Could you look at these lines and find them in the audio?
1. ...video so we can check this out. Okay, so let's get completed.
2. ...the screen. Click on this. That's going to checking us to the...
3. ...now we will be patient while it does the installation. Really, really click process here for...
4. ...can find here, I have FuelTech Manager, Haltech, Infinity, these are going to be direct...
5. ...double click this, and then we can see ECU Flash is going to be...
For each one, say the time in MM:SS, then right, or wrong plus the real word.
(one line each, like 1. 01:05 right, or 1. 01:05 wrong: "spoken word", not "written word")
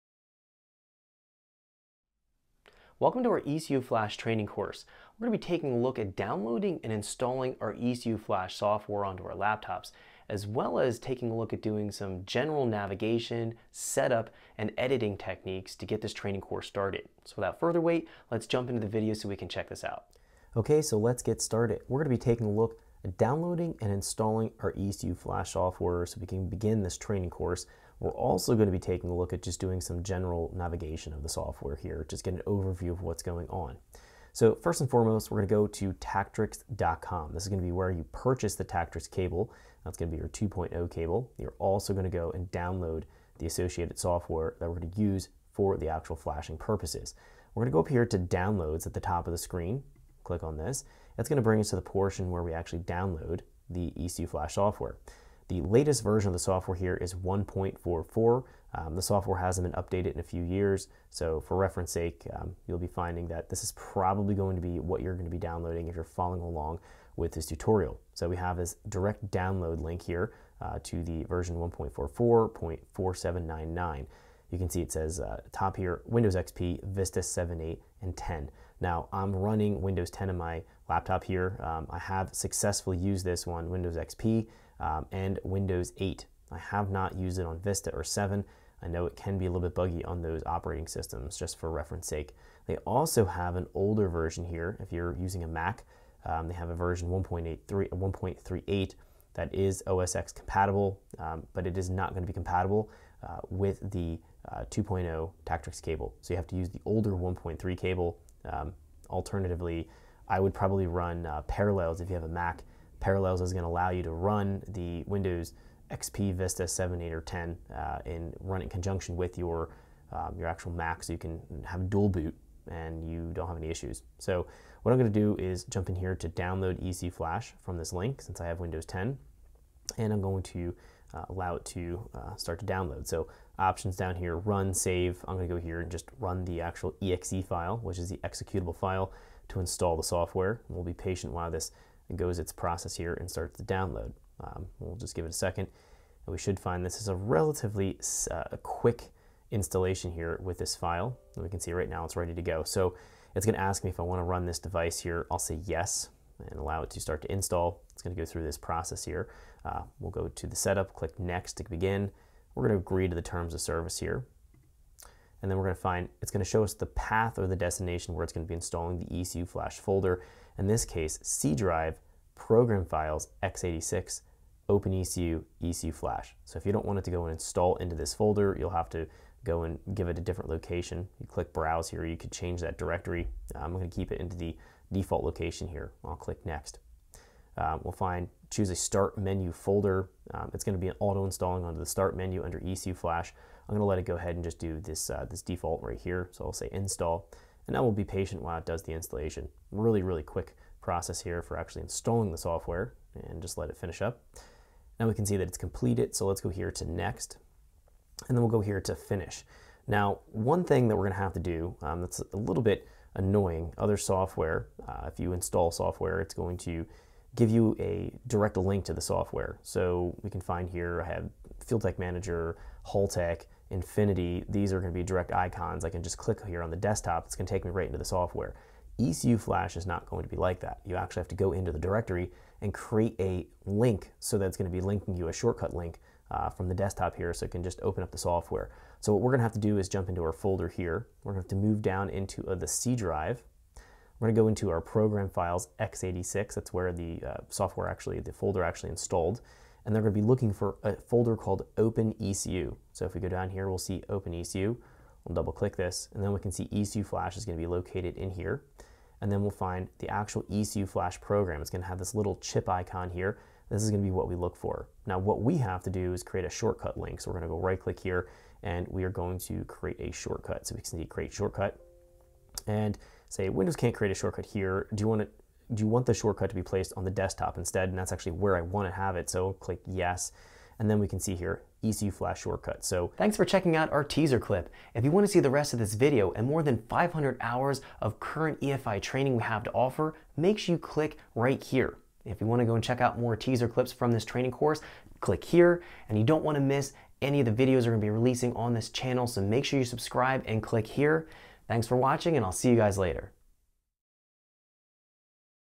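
1. 00:18 wrong: "started", not "completed"
2. 00:49 wrong: "bring", not "checking"
3. 03:17 wrong: "quick", not "click"
4. 03:40 right
5. 04:15 right.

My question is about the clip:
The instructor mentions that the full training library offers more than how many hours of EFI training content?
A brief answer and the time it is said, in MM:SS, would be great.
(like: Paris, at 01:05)
500, at 04:46.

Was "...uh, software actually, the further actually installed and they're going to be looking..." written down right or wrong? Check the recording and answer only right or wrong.
wrong.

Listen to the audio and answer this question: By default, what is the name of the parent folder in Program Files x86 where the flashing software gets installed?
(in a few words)
OpenECU.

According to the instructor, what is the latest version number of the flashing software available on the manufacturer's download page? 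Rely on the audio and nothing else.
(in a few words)
1.44.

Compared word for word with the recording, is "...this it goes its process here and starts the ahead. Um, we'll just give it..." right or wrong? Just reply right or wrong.
wrong.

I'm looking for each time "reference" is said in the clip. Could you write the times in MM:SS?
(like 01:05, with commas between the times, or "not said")
01:01, 01:31.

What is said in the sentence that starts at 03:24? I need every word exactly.
Now we can see that it's completed, so let's go here to next, and then we'll go here to finish.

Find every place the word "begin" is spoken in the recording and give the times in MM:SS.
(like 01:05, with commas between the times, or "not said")
00:26, 02:41.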